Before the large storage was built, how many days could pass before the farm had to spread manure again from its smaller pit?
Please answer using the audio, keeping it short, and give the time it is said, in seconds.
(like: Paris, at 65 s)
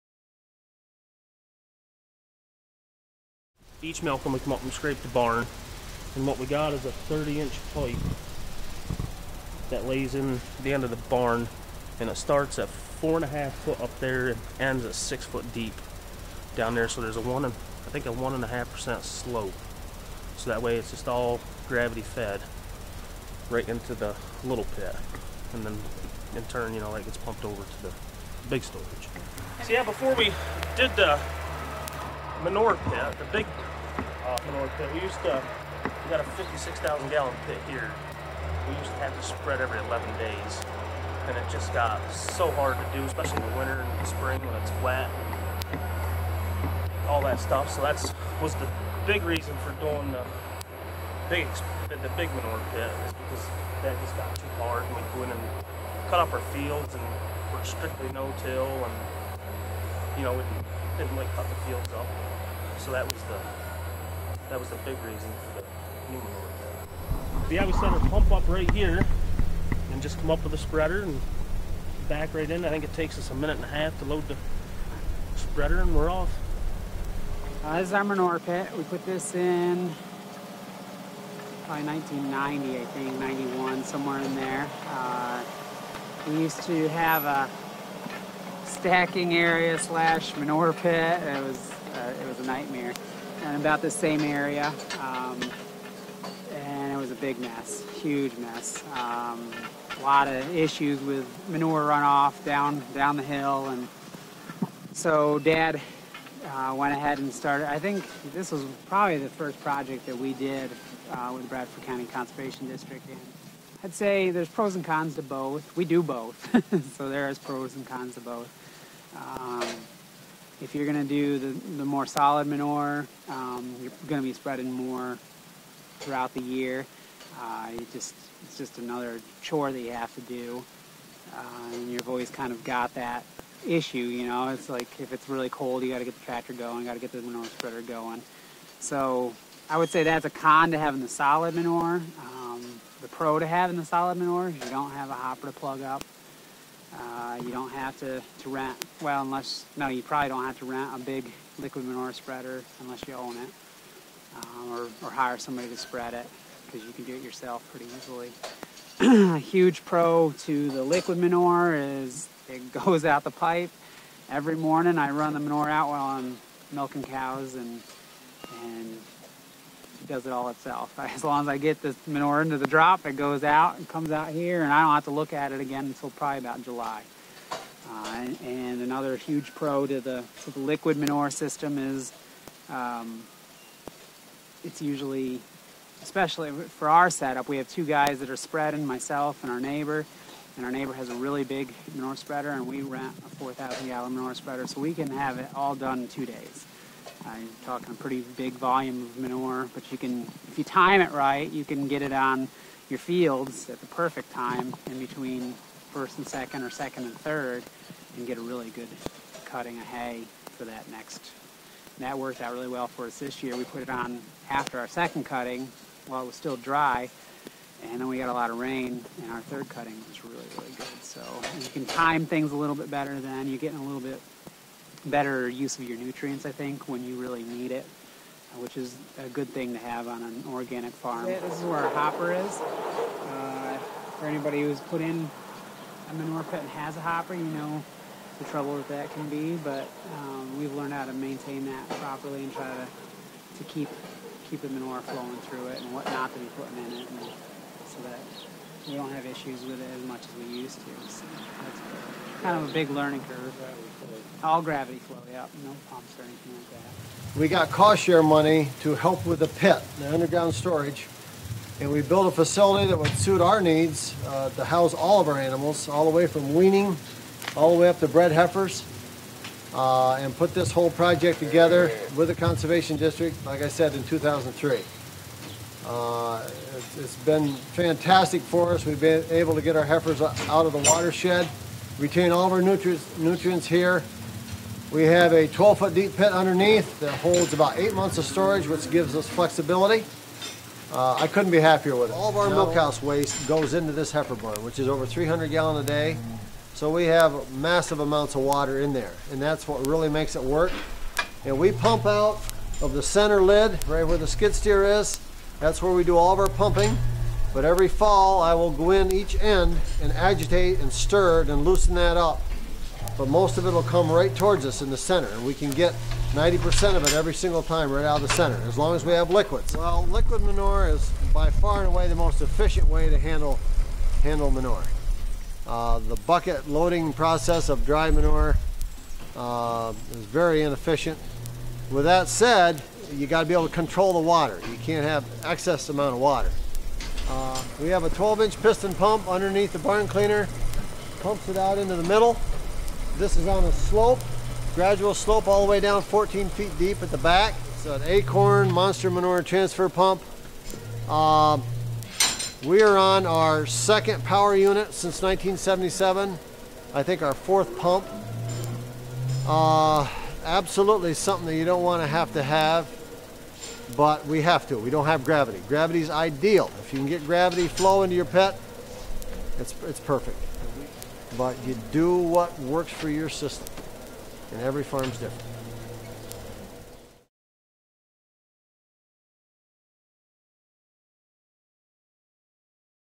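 11 days, at 39 s.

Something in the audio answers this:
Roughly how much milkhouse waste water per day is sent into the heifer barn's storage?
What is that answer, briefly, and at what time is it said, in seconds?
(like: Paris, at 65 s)
over 300 gallons, at 294 s.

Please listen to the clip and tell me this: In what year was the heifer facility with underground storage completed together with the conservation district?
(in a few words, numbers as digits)
2003.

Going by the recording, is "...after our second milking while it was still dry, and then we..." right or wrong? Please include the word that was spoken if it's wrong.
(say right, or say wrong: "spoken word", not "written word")
wrong: "cutting", not "milking".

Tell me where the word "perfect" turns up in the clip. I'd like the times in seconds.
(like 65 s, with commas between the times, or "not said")
203 s, 369 s.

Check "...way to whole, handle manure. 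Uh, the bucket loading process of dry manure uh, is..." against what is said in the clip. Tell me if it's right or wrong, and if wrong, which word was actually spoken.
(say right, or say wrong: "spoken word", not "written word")
wrong: "handle", not "whole".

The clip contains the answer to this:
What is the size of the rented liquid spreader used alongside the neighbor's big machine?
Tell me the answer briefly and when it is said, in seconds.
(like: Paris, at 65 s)
4,000 gallons, at 193 s.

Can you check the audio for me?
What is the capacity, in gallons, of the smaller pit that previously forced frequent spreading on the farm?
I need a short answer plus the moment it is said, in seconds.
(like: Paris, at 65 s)
56,000 gallons, at 36 s.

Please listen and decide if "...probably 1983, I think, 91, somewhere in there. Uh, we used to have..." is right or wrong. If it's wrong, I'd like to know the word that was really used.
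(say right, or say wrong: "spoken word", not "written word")
wrong: "1990", not "1983".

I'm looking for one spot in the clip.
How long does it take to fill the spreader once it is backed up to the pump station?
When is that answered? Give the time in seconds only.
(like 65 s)
73 s.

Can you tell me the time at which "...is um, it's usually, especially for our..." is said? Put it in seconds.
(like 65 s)
181 s.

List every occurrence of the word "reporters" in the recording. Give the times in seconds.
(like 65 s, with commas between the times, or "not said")
not said.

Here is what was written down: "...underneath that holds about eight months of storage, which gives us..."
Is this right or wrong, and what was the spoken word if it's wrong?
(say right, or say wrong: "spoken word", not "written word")
right.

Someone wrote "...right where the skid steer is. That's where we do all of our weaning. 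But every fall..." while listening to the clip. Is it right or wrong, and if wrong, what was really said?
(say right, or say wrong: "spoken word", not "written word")
wrong: "pumping", not "weaning".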